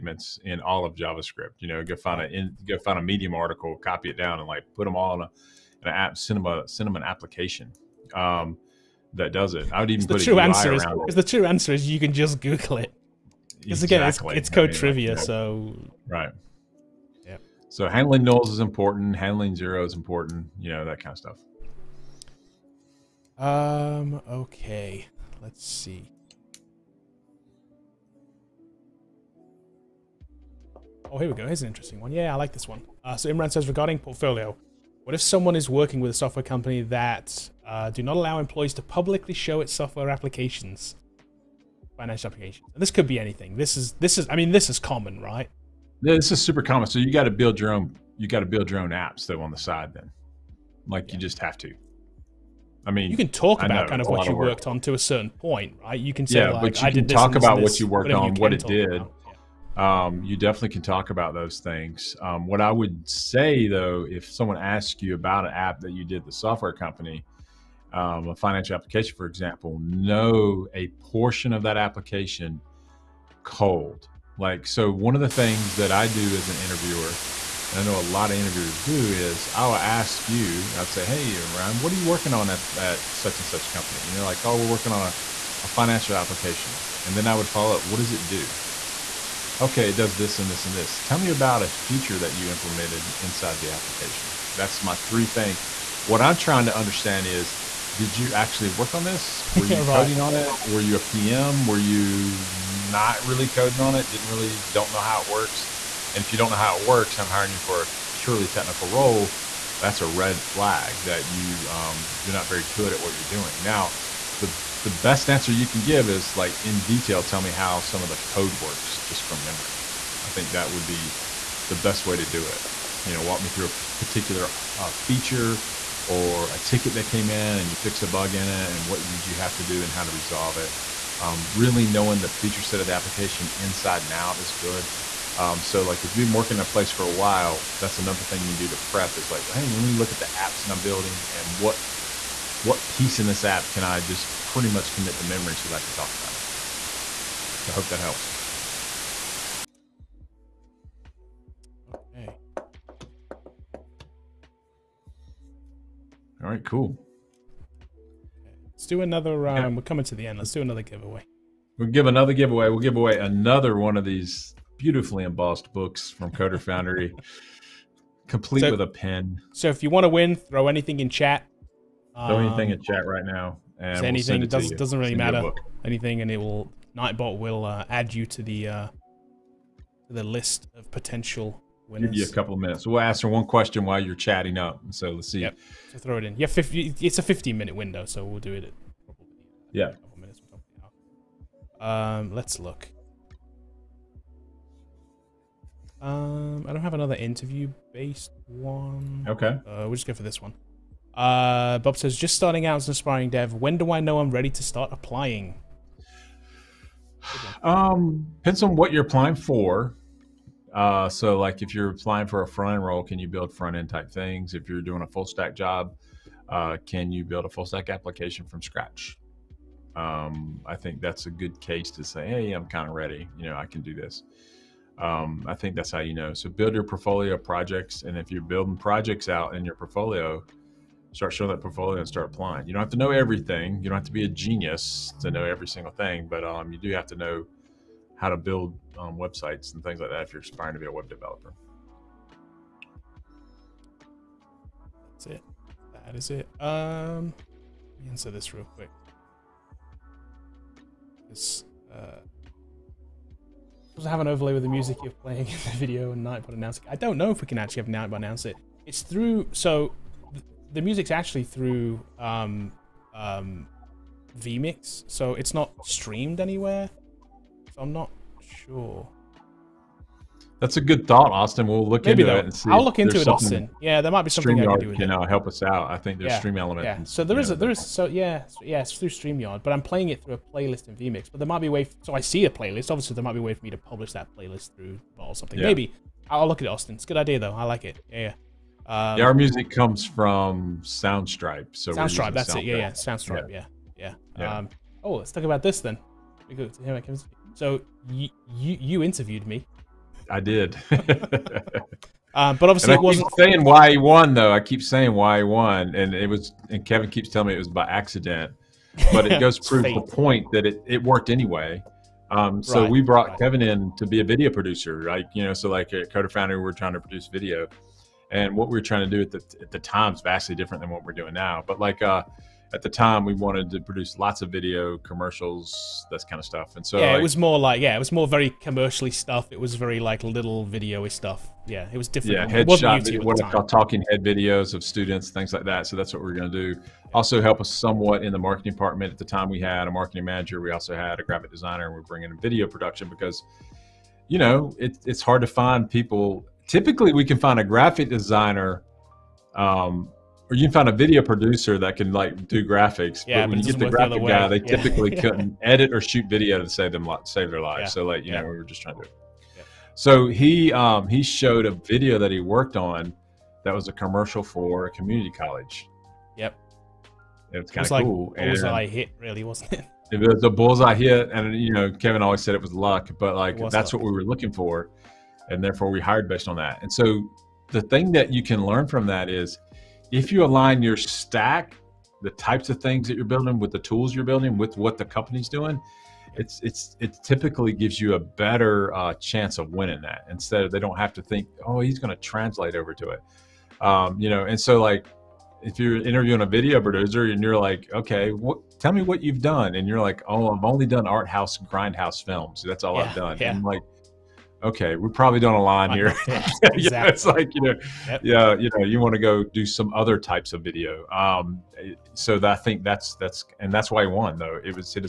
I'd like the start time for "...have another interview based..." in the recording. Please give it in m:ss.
3:16.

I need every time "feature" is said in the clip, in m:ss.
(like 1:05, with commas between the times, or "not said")
1:31, 2:04, 2:12.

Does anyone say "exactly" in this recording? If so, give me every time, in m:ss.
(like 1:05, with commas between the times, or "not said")
0:13, 6:46.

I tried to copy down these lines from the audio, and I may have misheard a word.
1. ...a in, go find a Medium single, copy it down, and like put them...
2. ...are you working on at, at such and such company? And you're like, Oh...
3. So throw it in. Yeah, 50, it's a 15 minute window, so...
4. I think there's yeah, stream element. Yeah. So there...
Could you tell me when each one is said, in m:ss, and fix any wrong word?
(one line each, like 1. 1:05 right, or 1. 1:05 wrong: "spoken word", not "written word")
1. 0:02 wrong: "article", not "single"
2. 1:21 right
3. 3:05 right
4. 4:35 right.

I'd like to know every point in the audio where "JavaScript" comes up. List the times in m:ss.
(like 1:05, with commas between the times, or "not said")
0:00.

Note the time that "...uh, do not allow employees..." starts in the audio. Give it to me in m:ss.
0:37.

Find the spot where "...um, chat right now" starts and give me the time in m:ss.
2:52.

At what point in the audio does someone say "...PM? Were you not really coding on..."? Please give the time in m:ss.
1:40.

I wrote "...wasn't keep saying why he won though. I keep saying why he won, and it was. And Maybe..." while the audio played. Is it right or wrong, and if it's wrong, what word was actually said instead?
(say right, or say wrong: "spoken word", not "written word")
wrong: "Kevin", not "Maybe".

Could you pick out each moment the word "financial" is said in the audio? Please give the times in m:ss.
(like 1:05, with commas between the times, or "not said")
0:41, 1:08, 1:25.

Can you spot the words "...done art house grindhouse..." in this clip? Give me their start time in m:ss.
6:40.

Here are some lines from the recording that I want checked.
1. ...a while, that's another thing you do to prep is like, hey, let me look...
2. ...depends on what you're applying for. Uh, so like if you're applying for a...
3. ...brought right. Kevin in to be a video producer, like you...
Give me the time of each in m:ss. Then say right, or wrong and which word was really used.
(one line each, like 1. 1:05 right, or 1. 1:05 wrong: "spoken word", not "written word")
1. 2:17 right
2. 3:28 right
3. 5:13 right.